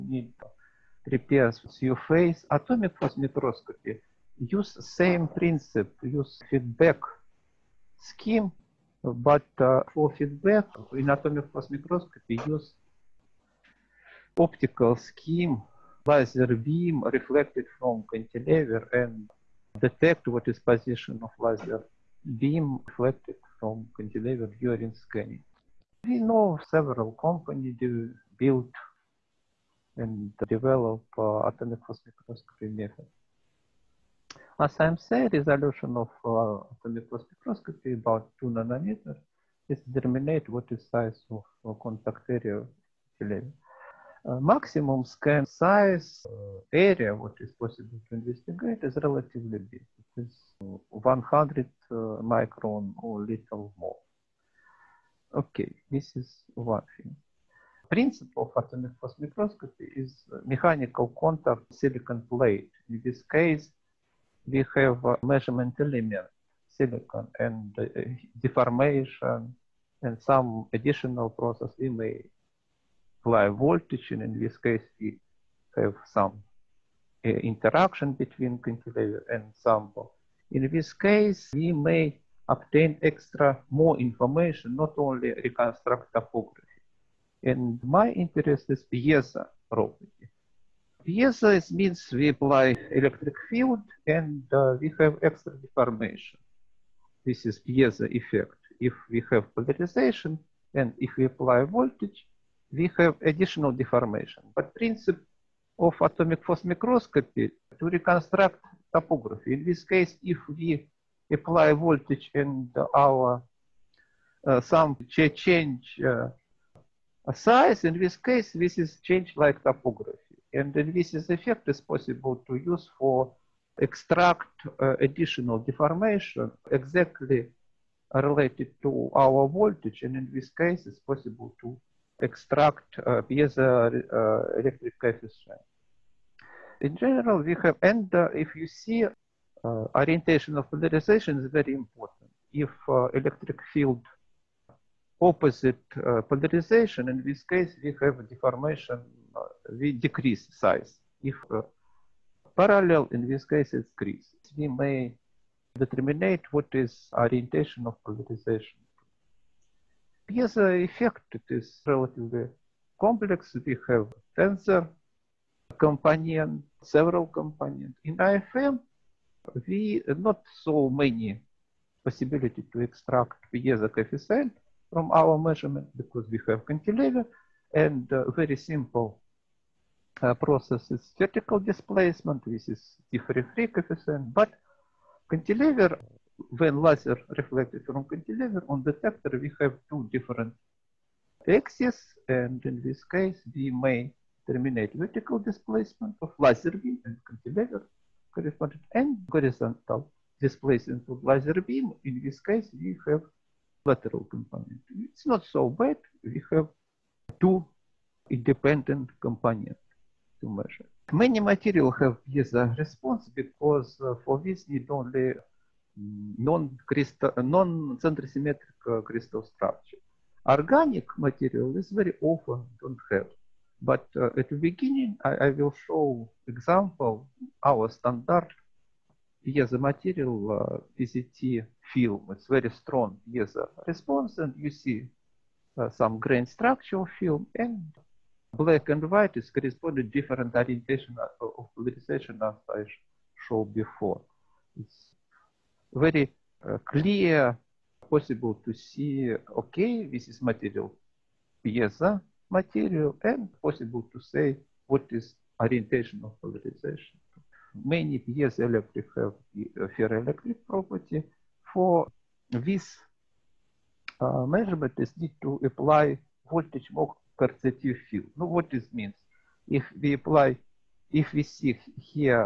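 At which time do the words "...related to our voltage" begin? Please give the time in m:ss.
2:08.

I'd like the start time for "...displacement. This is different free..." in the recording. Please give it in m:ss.
3:01.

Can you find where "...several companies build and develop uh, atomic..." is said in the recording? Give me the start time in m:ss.
0:26.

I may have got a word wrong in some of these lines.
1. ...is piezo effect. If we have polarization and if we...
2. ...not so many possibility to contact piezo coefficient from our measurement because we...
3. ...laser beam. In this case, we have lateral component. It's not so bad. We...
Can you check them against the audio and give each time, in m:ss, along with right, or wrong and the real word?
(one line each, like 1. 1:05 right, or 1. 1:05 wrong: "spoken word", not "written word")
1. 1:37 right
2. 2:50 wrong: "extract", not "contact"
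3. 3:21 right.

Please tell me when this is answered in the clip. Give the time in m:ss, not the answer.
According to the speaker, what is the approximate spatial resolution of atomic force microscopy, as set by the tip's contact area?
0:38.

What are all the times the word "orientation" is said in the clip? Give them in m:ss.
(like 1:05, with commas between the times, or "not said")
2:19, 2:37, 4:00, 4:15.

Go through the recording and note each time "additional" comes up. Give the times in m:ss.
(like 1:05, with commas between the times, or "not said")
1:10, 1:43, 2:05.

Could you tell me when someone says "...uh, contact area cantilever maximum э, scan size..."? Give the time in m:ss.
0:41.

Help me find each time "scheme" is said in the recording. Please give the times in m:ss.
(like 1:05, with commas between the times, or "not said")
0:08, 0:14.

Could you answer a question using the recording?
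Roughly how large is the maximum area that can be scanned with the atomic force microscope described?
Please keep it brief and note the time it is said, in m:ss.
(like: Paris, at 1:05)
100 microns, at 0:50.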